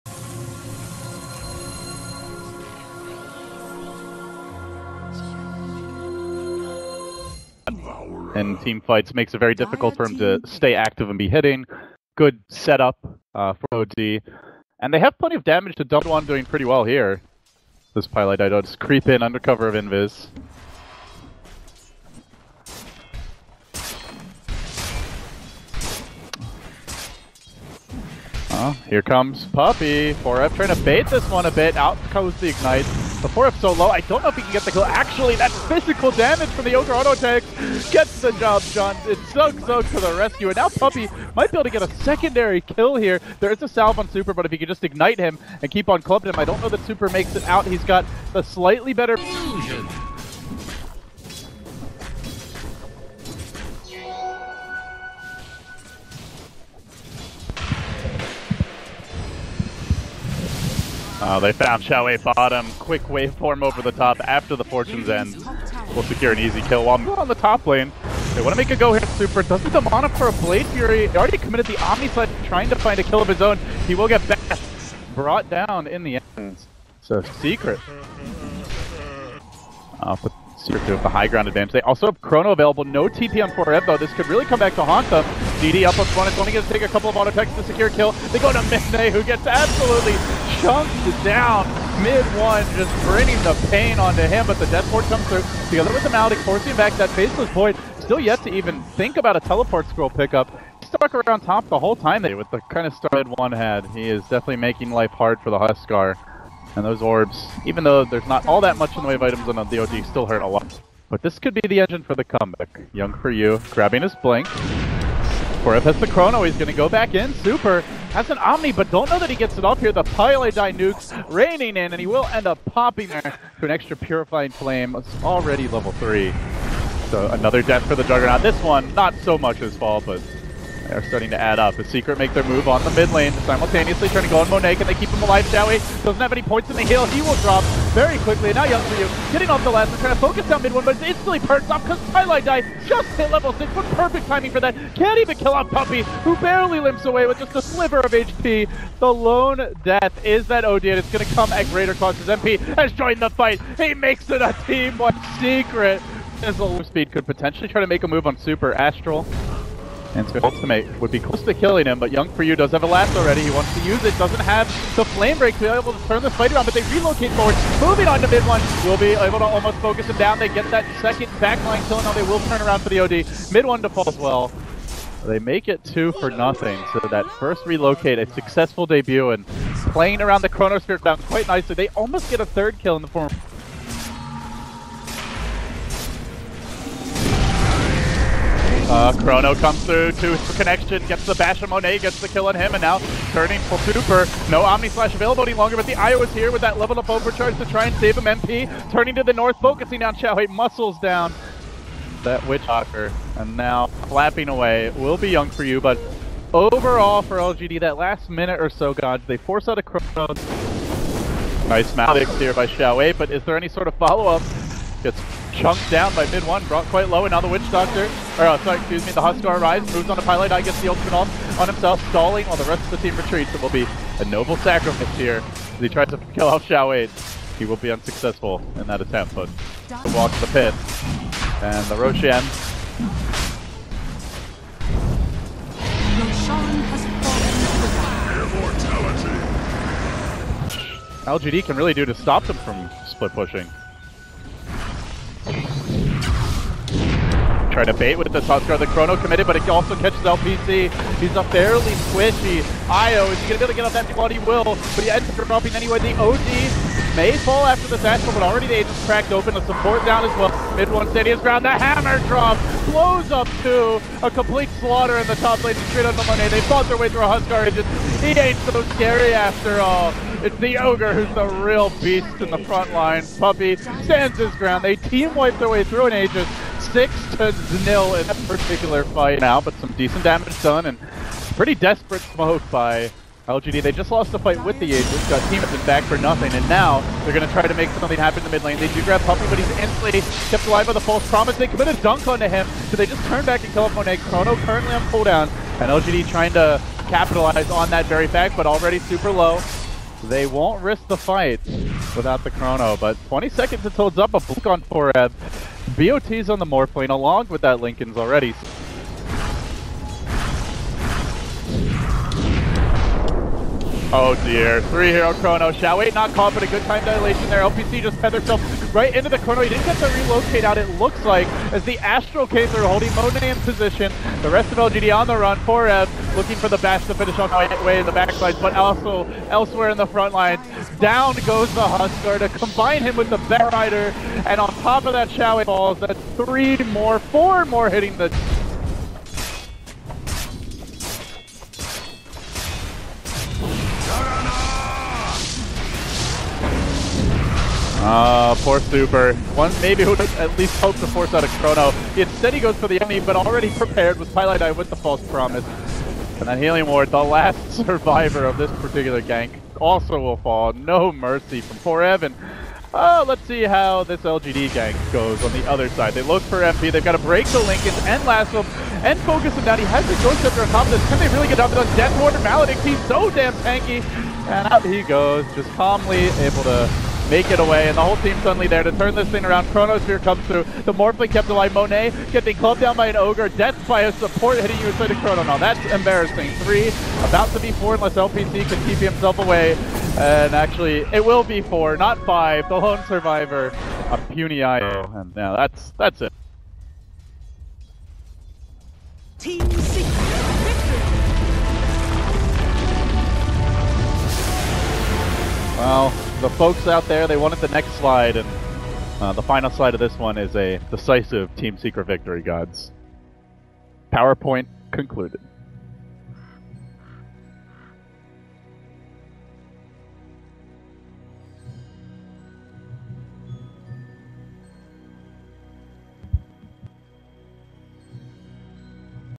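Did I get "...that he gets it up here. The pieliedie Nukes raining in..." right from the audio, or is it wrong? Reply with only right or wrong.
right.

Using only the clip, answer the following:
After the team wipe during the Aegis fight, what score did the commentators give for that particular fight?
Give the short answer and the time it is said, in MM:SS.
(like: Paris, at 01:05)
6 to 0, at 04:36.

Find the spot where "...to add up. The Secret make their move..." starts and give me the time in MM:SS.
02:11.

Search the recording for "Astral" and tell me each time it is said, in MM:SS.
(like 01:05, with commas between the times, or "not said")
02:38, 05:21.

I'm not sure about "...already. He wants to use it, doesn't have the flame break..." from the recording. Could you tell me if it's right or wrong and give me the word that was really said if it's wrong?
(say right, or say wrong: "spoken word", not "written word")
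right.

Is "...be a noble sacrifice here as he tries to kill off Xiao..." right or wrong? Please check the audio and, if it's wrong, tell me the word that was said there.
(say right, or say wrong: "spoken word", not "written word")
right.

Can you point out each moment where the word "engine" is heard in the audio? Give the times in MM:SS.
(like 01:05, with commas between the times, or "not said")
01:51.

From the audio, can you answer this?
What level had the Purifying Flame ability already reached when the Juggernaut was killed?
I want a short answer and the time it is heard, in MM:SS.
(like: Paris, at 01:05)
3, at 02:05.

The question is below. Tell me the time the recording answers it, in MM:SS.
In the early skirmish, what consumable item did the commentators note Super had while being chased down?
00:43.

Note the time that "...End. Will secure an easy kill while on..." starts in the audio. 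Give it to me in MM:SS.
01:05.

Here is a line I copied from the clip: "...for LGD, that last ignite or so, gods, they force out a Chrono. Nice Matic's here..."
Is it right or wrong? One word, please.
wrong.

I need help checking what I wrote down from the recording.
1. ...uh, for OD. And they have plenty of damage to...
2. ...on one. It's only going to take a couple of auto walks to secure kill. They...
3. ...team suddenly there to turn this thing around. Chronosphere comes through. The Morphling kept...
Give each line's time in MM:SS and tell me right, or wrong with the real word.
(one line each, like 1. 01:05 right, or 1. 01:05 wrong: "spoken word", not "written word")
1. 00:13 right
2. 01:25 wrong: "attacks", not "walks"
3. 06:18 right.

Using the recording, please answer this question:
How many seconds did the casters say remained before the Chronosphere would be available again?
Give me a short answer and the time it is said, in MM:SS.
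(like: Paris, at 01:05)
20, at 05:03.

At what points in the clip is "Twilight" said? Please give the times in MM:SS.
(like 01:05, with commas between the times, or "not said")
02:22, 05:54.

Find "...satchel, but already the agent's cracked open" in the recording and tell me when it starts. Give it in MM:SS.
04:17.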